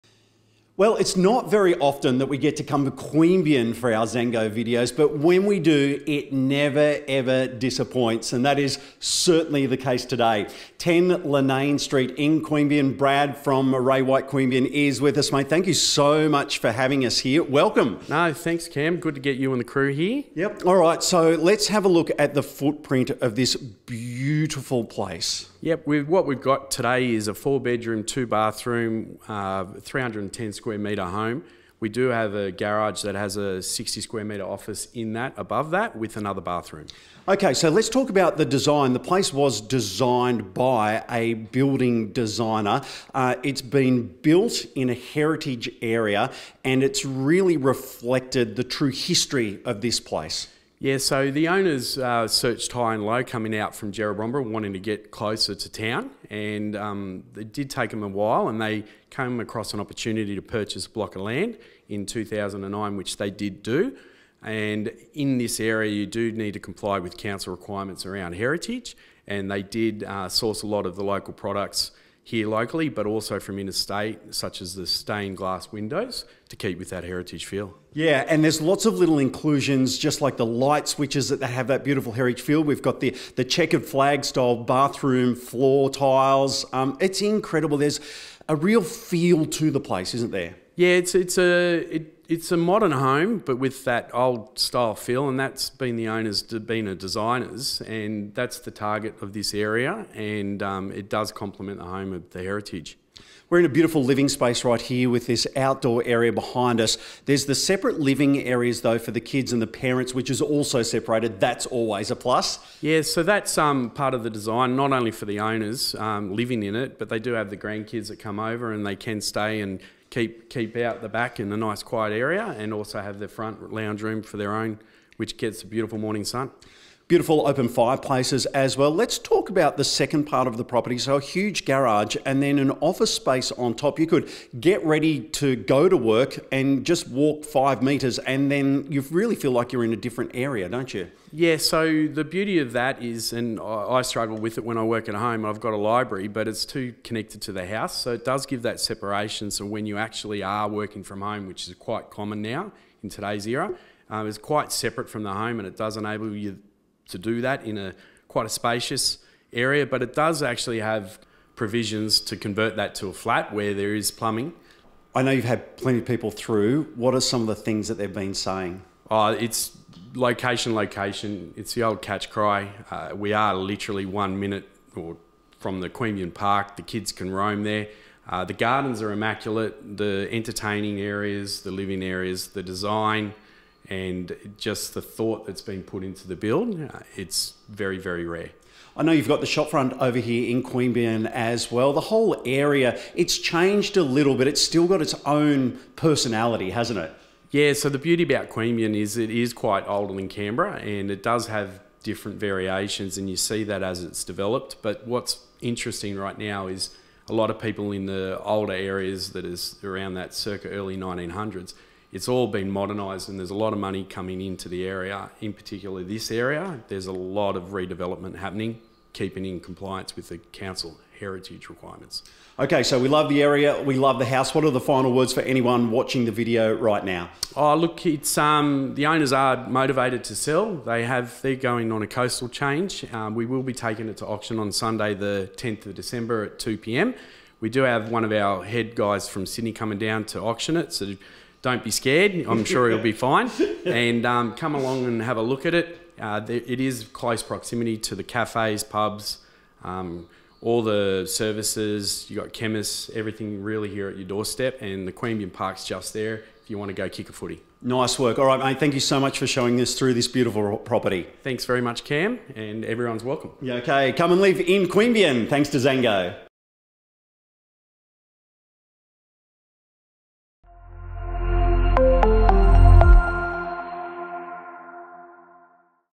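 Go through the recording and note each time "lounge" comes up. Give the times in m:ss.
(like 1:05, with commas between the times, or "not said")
2:03.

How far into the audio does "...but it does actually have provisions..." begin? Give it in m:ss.
2:39.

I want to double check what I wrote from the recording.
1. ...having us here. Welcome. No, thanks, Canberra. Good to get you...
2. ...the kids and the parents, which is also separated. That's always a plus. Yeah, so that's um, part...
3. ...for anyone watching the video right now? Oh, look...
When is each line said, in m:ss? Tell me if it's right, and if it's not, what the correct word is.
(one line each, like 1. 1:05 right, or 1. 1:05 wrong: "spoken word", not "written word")
1. 0:16 wrong: "Cam", not "Canberra"
2. 1:49 right
3. 3:45 right.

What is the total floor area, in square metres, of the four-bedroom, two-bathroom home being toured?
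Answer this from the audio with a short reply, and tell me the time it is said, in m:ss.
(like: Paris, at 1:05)
310, at 0:29.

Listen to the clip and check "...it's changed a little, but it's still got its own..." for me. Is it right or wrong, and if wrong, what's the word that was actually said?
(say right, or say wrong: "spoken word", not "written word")
right.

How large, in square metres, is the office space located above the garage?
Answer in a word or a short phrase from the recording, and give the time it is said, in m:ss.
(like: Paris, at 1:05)
60, at 0:33.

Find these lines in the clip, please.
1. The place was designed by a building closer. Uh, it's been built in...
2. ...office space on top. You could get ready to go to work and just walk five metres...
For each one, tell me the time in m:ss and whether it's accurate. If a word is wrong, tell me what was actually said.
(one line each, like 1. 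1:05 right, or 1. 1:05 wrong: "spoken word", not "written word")
1. 0:38 wrong: "designer", not "closer"
2. 2:12 right.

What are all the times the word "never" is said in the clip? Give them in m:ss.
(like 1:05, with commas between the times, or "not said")
0:06.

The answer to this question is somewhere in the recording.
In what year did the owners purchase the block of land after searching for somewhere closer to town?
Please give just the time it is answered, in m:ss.
1:02.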